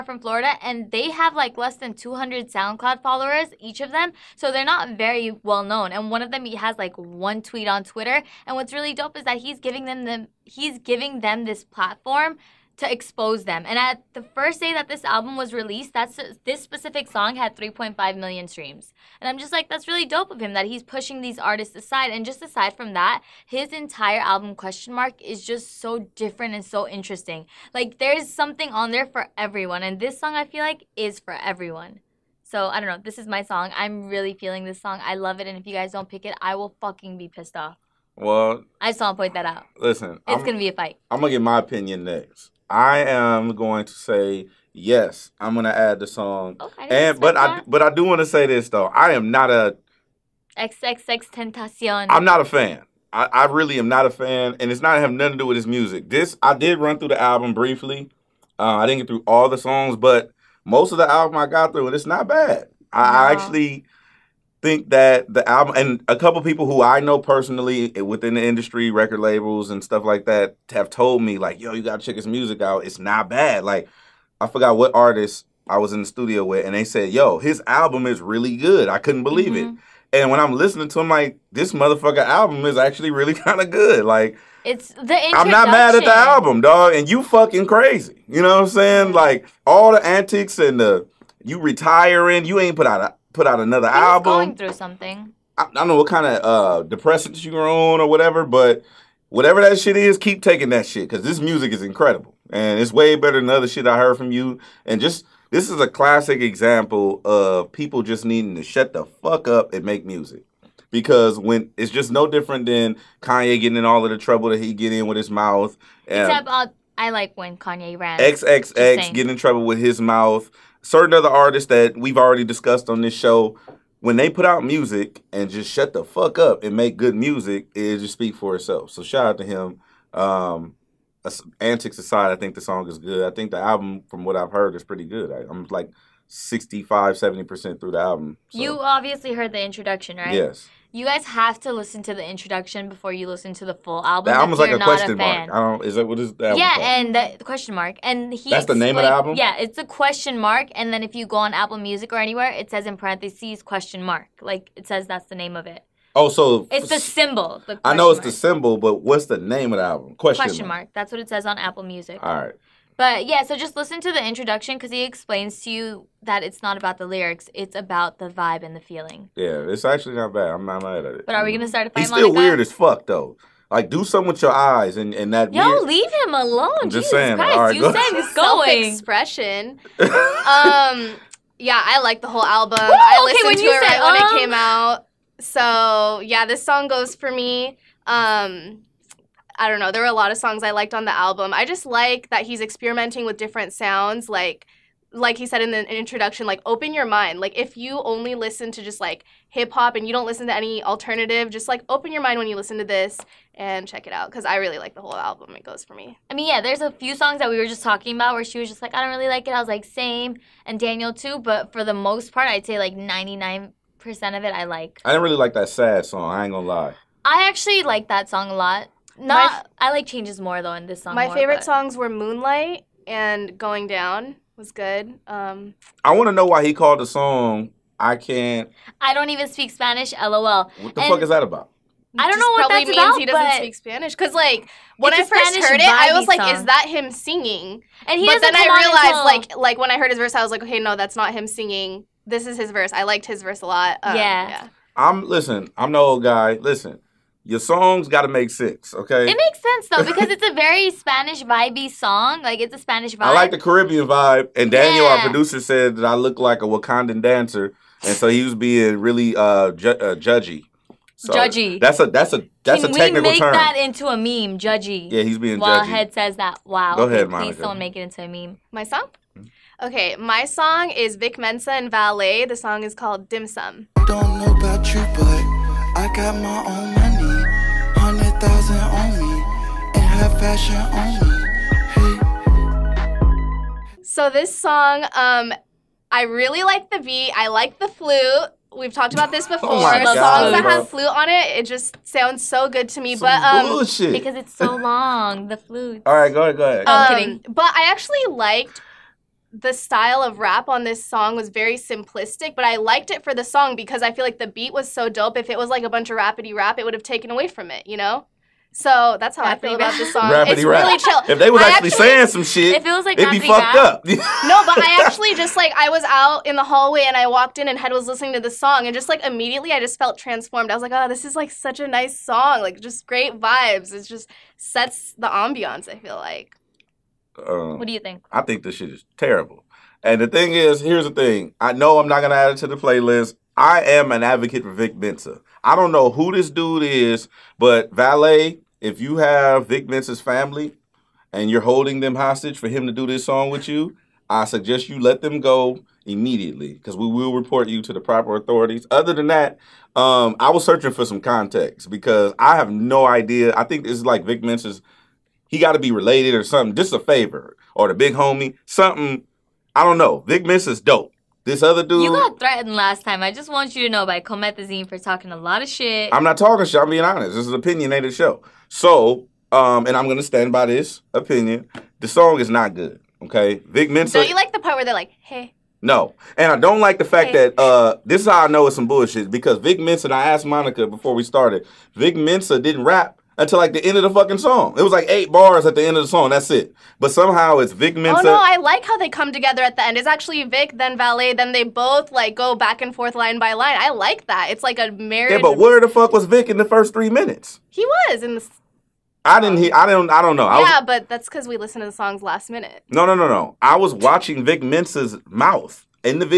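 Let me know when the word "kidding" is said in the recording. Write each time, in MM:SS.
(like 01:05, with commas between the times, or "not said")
04:57.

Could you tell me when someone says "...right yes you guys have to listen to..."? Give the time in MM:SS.
02:20.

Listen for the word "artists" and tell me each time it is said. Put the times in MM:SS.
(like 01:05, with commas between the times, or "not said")
00:21, 01:14, 02:01.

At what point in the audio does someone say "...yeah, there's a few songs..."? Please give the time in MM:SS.
03:26.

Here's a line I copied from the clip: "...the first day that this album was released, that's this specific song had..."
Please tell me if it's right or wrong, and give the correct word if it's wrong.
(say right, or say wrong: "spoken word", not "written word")
right.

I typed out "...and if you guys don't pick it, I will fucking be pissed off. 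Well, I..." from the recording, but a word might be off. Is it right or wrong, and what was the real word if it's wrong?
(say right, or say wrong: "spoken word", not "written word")
right.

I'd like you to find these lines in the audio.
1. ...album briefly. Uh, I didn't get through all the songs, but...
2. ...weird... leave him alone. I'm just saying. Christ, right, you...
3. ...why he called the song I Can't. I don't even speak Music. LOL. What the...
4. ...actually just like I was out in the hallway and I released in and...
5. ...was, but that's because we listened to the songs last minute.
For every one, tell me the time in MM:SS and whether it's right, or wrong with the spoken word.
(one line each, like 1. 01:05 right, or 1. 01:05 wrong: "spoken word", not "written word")
1. 00:57 right
2. 02:55 right
3. 03:46 wrong: "Spanish", not "Music"
4. 05:15 wrong: "walked", not "released"
5. 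06:40 right.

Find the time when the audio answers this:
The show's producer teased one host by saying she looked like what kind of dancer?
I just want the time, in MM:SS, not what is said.
04:16.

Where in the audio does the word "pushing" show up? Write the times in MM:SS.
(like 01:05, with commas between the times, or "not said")
00:20.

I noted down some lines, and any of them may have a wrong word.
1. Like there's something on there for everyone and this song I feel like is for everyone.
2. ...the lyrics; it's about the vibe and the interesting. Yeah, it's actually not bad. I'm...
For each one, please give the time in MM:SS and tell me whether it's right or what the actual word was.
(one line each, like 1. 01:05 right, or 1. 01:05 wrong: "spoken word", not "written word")
1. 00:27 right
2. 02:46 wrong: "feeling", not "interesting".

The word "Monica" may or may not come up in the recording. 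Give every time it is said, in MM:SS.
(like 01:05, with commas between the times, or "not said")
04:27, 06:20.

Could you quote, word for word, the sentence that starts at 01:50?
Because when it's just no different than Kanye getting in all of the trouble that he get in with his mouth.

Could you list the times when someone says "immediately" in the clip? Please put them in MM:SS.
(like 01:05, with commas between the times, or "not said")
05:19, 05:46.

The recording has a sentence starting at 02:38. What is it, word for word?
the symbol, but what's the name of the album?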